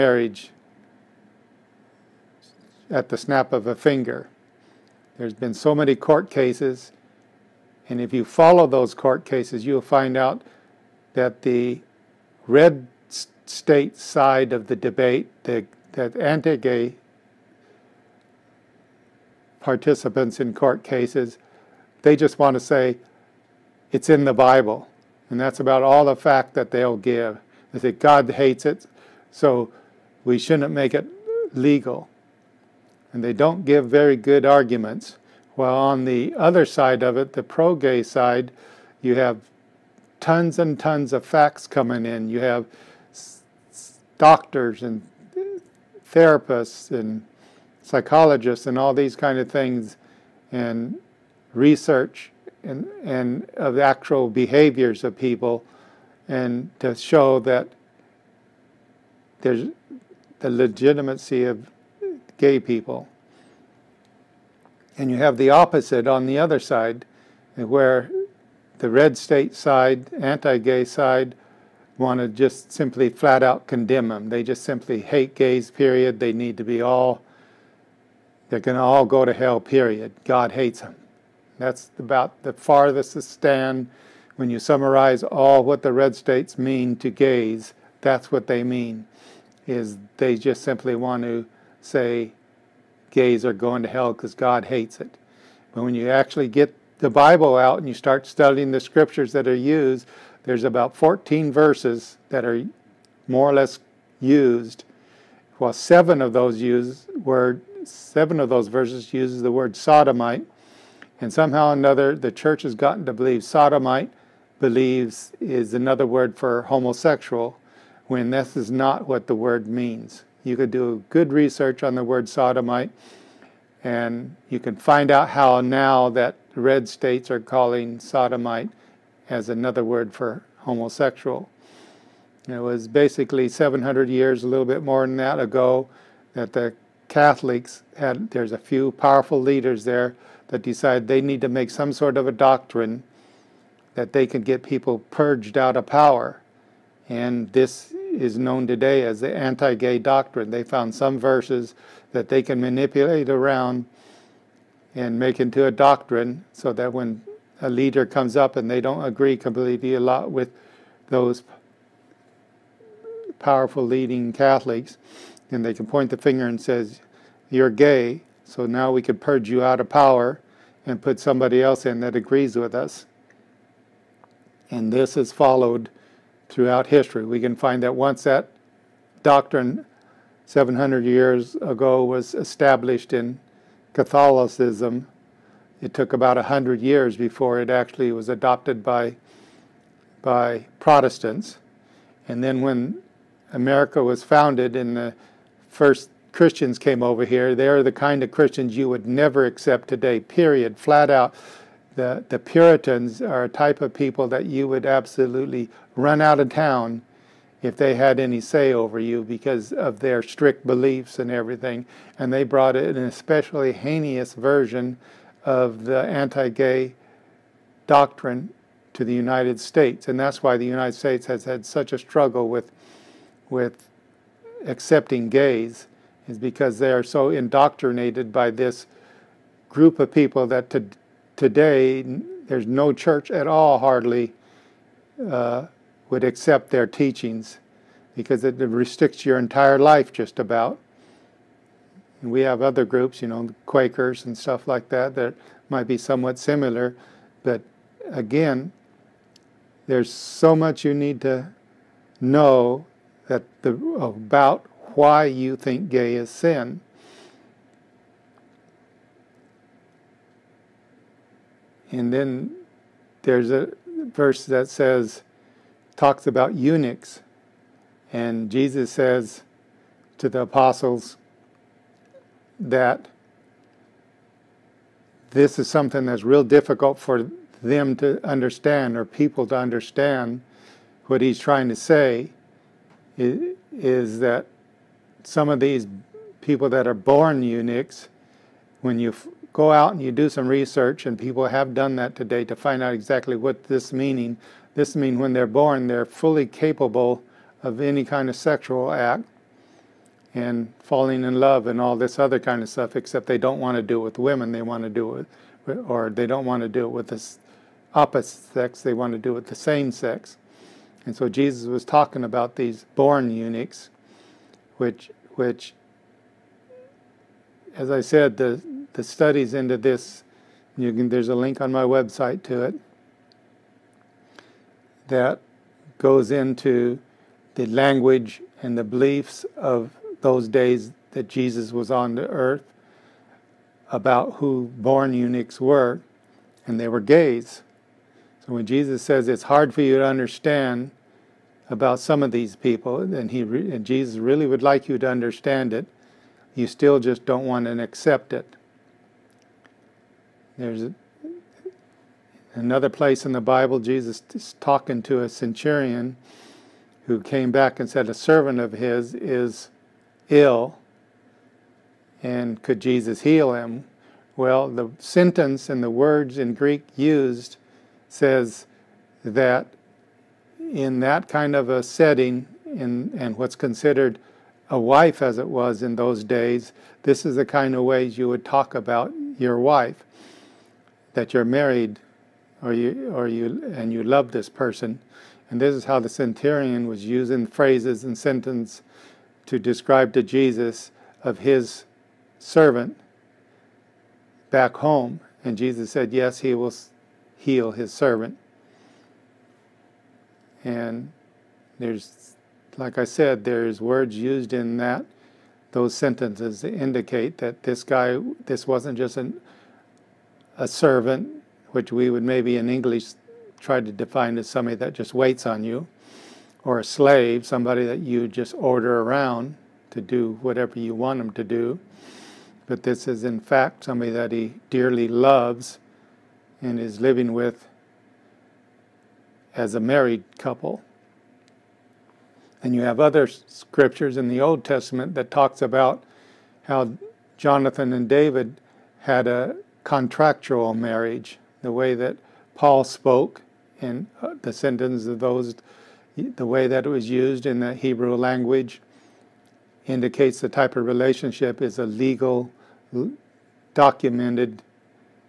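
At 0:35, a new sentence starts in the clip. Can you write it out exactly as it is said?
While on the other side of it, the pro gay side, you have tons and tons of facts coming in.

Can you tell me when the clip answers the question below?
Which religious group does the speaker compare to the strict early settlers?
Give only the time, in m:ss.
4:03.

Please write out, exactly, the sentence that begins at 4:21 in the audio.
And then there's a verse that says, talks about eunuchs.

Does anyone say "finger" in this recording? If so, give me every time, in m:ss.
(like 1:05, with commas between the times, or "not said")
0:03, 2:46.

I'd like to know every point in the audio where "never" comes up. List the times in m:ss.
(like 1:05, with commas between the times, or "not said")
3:19.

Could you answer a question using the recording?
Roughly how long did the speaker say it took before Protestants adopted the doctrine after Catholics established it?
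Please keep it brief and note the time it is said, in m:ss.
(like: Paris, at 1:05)
100 years, at 3:06.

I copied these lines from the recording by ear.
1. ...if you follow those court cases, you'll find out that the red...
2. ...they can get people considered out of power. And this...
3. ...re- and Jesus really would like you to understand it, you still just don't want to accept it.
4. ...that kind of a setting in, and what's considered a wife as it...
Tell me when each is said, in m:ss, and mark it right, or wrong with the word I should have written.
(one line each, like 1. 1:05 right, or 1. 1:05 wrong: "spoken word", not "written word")
1. 0:08 right
2. 2:24 wrong: "purged", not "considered"
3. 5:43 right
4. 6:11 right.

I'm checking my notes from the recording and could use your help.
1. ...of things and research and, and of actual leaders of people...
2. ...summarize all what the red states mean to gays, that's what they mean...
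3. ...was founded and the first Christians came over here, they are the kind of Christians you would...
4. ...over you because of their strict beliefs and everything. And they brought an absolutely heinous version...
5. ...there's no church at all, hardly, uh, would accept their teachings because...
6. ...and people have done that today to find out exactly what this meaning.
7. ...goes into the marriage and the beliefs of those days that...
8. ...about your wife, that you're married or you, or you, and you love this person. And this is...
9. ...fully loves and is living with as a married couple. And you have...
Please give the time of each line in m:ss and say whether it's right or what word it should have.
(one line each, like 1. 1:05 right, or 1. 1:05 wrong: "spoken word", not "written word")
1. 0:49 wrong: "behaviors", not "leaders"
2. 1:24 right
3. 3:14 right
4. 3:28 wrong: "especially", not "absolutely"
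5. 3:52 right
6. 4:51 right
7. 5:25 wrong: "language", not "marriage"
8. 6:18 right
9. 7:04 wrong: "dearly", not "fully".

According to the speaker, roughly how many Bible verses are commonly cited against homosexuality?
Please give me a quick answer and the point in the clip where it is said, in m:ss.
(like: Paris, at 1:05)
14, at 1:40.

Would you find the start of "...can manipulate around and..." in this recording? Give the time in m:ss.
2:32.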